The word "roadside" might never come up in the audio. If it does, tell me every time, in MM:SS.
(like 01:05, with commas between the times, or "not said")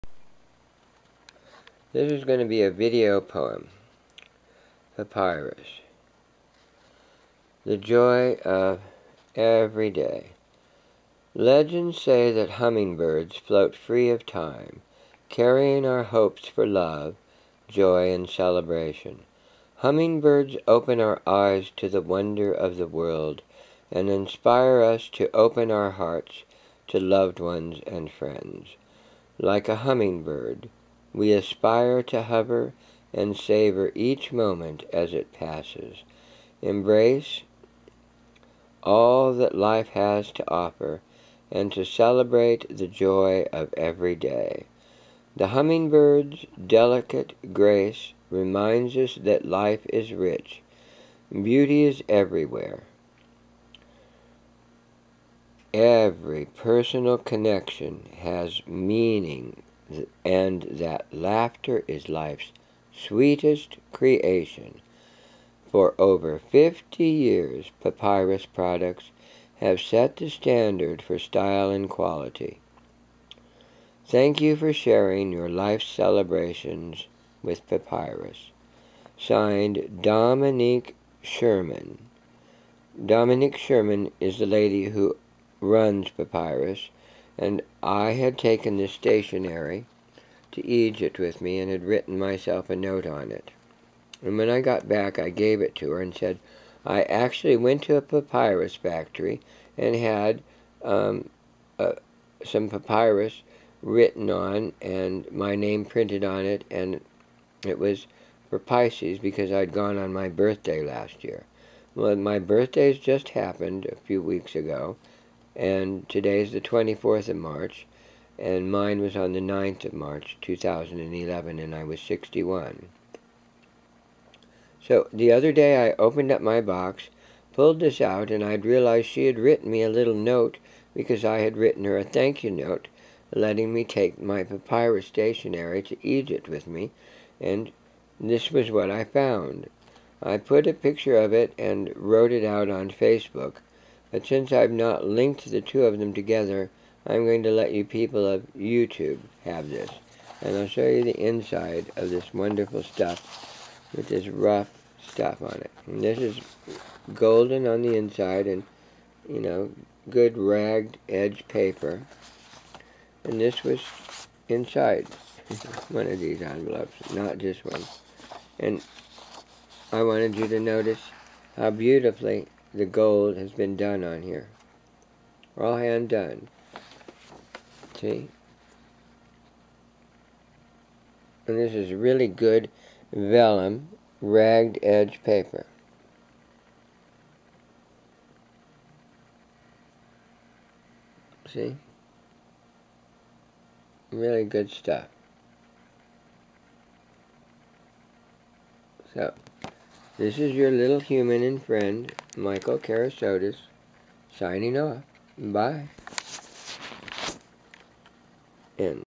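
not said.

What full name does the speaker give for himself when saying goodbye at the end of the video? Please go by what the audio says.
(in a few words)
Michael Kerasotes.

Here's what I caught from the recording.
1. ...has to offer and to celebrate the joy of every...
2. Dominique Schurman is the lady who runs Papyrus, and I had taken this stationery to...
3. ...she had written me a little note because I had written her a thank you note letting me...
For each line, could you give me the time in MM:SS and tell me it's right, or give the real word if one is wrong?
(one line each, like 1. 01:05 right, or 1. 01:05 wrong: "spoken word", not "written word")
1. 00:39 right
2. 01:23 right
3. 02:09 right.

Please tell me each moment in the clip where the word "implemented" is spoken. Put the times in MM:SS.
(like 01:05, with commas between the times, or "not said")
not said.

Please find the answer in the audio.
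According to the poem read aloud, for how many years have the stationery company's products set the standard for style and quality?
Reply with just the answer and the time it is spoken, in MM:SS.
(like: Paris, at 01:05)
Over 50, at 01:05.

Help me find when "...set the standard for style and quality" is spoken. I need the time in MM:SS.
01:09.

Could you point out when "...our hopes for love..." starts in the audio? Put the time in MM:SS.
00:15.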